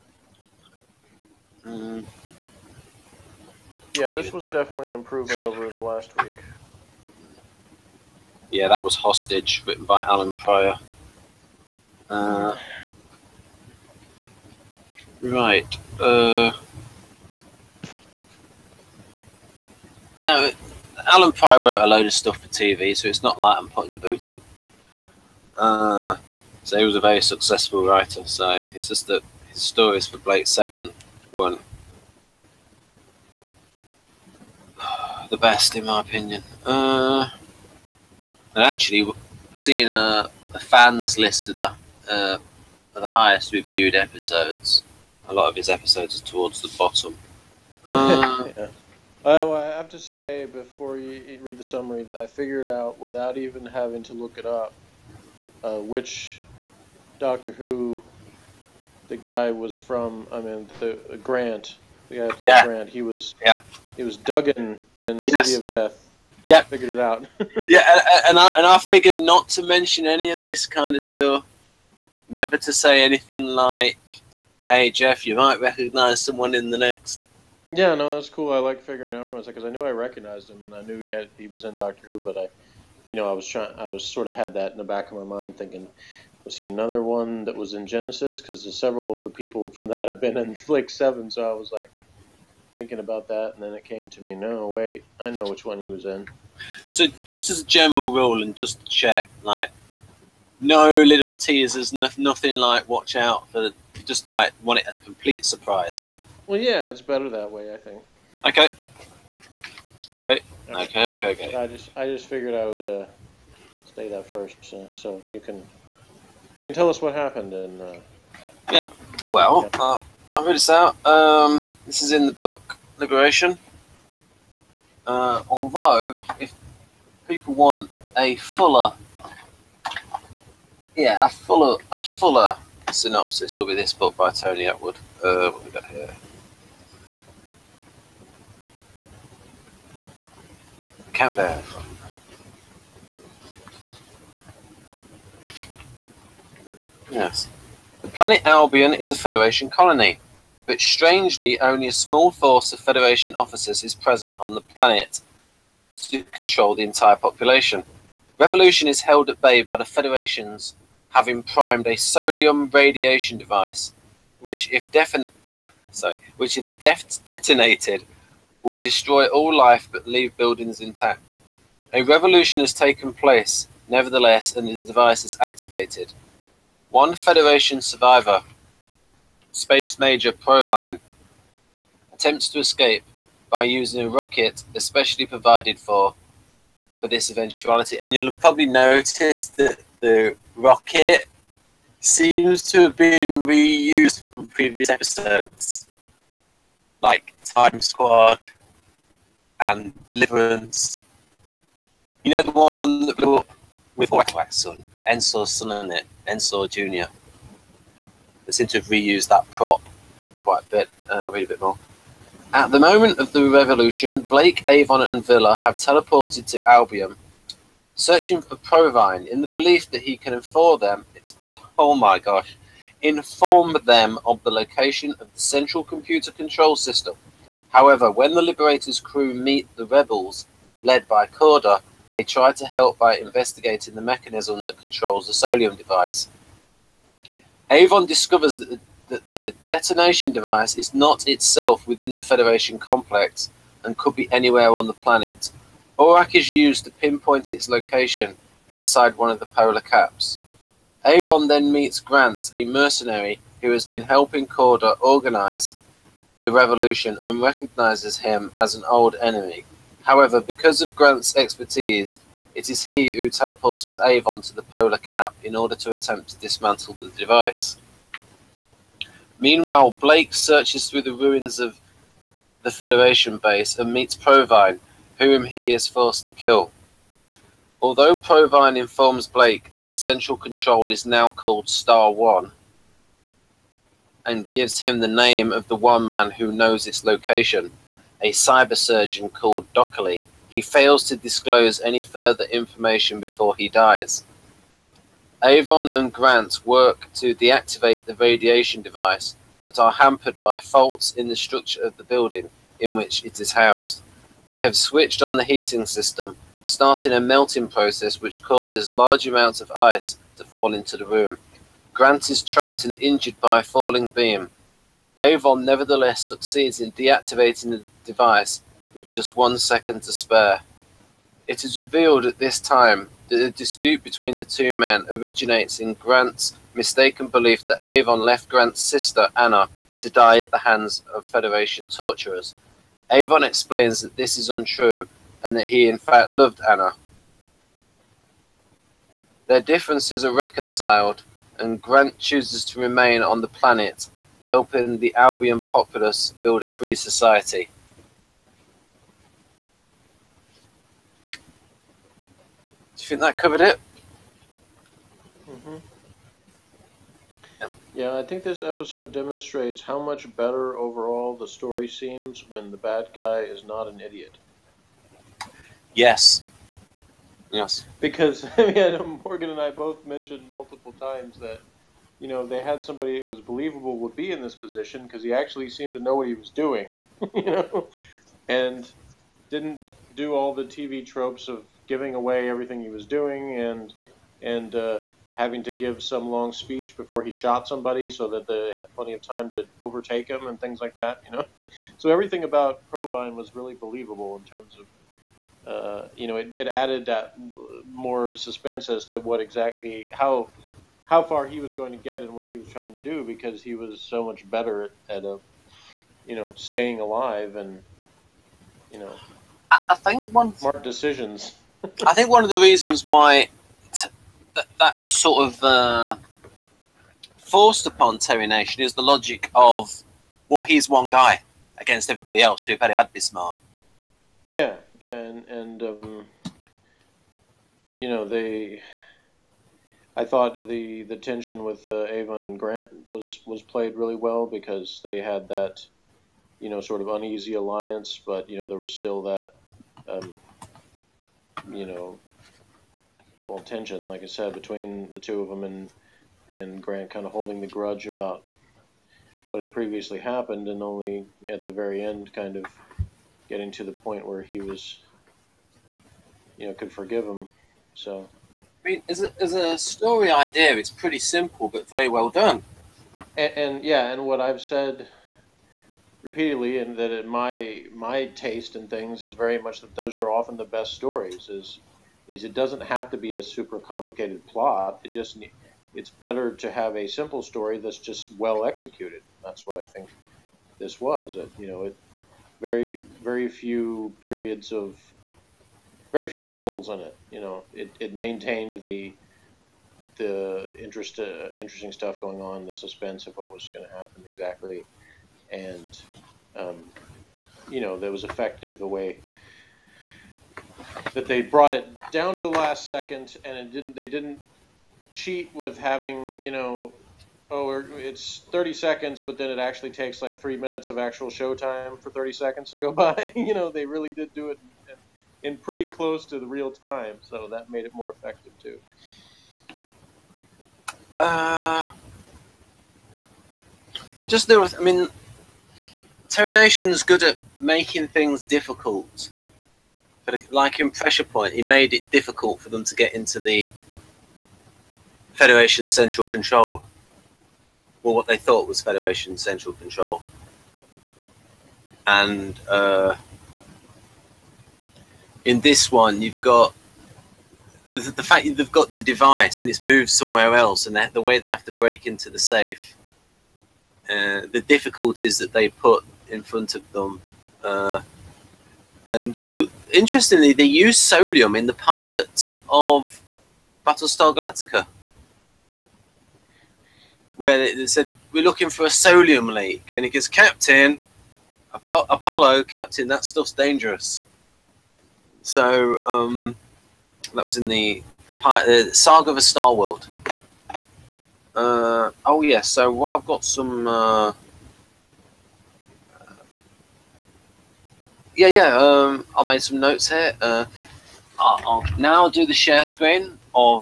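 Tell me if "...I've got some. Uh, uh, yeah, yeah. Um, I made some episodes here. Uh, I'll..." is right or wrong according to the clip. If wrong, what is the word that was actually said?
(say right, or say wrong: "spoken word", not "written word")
wrong: "notes", not "episodes".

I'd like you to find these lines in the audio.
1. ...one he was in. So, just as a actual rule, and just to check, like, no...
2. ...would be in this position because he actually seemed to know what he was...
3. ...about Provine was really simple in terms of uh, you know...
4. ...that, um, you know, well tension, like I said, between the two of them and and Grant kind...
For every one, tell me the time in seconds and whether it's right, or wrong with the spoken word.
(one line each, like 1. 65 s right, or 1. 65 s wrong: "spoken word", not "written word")
1. 95 s wrong: "general", not "actual"
2. 373 s right
3. 392 s wrong: "believable", not "simple"
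4. 439 s right.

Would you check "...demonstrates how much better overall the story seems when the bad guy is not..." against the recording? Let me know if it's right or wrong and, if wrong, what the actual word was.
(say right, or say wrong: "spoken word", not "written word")
right.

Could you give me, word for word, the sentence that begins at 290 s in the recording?
He fails to disclose any further information before he dies.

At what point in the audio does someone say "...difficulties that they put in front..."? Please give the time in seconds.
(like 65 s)
554 s.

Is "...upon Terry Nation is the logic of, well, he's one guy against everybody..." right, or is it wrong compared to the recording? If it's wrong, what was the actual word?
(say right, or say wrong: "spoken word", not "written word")
right.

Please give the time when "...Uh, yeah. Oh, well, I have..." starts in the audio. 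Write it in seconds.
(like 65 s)
47 s.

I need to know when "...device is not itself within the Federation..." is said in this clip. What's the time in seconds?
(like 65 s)
240 s.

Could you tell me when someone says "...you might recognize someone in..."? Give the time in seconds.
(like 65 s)
75 s.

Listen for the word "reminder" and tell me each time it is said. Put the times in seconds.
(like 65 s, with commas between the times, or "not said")
not said.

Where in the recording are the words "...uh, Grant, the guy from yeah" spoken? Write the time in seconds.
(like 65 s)
61 s.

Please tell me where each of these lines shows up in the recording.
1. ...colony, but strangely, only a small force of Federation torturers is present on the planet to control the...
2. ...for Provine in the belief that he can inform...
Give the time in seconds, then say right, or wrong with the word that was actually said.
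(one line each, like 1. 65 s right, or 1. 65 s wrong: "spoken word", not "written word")
1. 149 s wrong: "officers", not "torturers"
2. 218 s right.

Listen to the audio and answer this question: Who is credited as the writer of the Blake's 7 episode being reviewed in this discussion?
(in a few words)
Allan Prior.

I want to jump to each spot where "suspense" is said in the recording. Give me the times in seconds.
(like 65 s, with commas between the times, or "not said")
398 s, 492 s.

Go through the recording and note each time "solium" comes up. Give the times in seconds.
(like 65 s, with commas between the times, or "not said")
161 s, 235 s, 560 s, 568 s.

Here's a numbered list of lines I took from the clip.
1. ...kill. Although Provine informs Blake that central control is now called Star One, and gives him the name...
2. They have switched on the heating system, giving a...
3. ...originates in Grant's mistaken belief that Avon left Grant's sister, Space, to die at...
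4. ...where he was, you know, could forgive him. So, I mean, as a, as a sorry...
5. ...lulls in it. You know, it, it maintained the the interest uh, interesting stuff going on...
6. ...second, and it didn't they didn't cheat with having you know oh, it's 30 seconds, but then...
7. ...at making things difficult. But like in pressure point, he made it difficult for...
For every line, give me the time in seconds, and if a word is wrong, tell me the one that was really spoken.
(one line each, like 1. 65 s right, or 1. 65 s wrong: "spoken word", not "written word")
1. 276 s right
2. 304 s wrong: "starting", not "giving"
3. 325 s wrong: "Anna", not "Space"
4. 454 s wrong: "story", not "sorry"
5. 486 s right
6. 502 s right
7. 527 s right.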